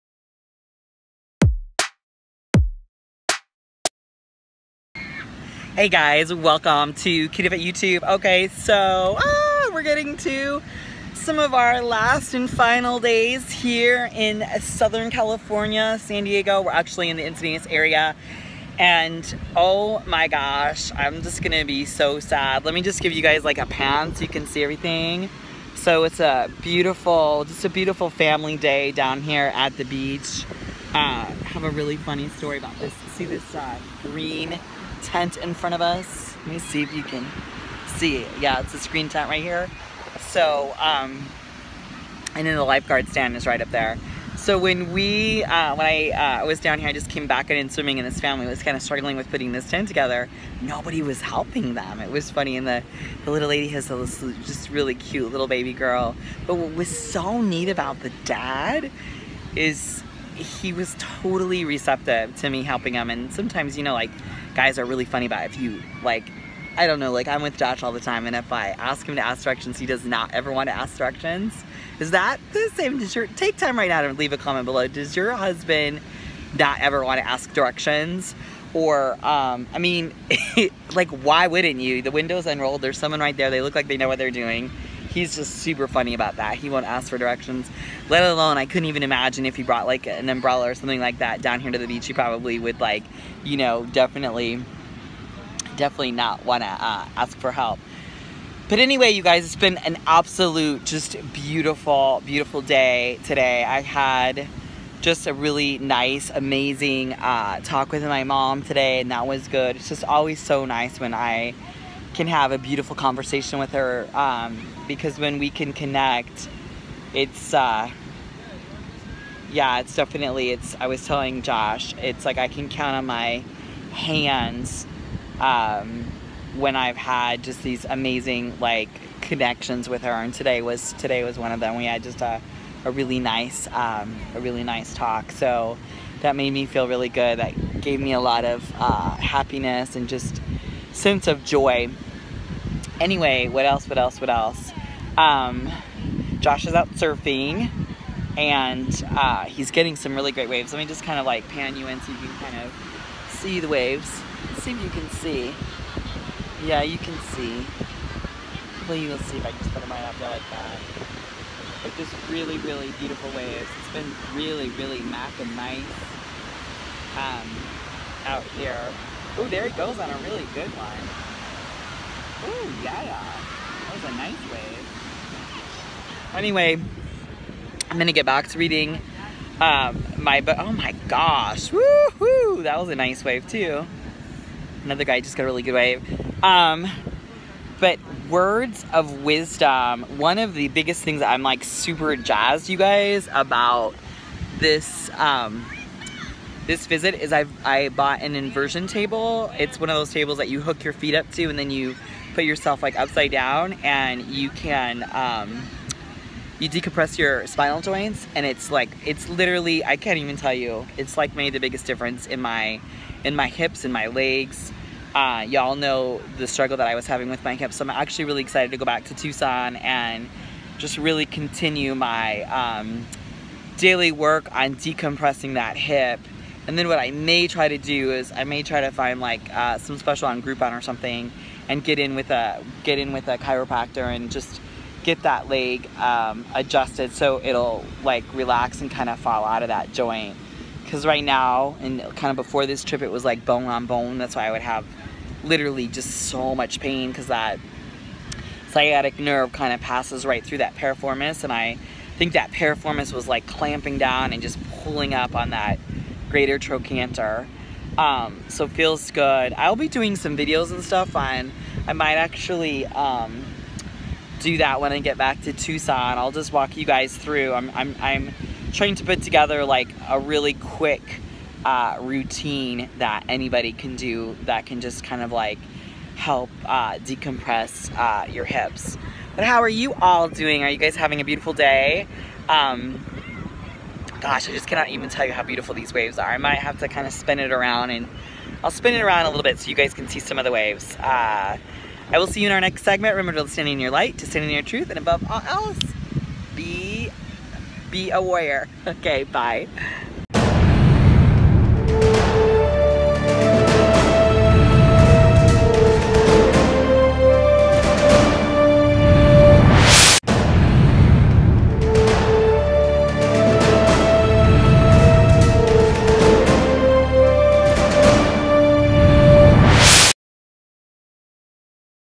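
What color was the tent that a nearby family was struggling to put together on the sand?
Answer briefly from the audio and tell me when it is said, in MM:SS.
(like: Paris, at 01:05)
Green, at 00:34.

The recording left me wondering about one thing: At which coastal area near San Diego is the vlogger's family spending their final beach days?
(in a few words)
Encinitas.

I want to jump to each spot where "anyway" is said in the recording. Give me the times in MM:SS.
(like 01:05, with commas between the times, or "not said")
01:38, 02:22, 02:56.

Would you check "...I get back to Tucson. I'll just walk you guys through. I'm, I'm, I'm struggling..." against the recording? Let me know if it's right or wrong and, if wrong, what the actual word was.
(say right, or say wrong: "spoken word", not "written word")
wrong: "trying", not "struggling".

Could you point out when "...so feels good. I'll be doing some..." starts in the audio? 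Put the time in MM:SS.
04:18.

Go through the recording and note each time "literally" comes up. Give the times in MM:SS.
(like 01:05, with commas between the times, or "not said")
03:29, 04:05.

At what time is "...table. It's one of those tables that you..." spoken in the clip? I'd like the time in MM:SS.
03:18.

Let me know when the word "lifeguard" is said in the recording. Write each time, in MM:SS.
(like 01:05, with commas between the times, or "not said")
00:42.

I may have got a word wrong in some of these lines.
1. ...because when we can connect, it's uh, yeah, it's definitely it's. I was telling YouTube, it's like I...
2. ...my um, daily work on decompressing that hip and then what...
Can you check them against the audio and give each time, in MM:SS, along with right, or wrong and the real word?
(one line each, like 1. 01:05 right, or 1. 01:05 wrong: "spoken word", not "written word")
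1. 01:54 wrong: "Josh", not "YouTube"
2. 03:41 right.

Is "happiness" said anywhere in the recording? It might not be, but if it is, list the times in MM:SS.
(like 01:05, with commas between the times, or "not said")
02:19.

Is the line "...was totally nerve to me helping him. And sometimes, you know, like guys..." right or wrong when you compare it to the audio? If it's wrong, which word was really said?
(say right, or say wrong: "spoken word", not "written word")
wrong: "receptive", not "nerve".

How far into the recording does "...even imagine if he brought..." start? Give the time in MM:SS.
01:28.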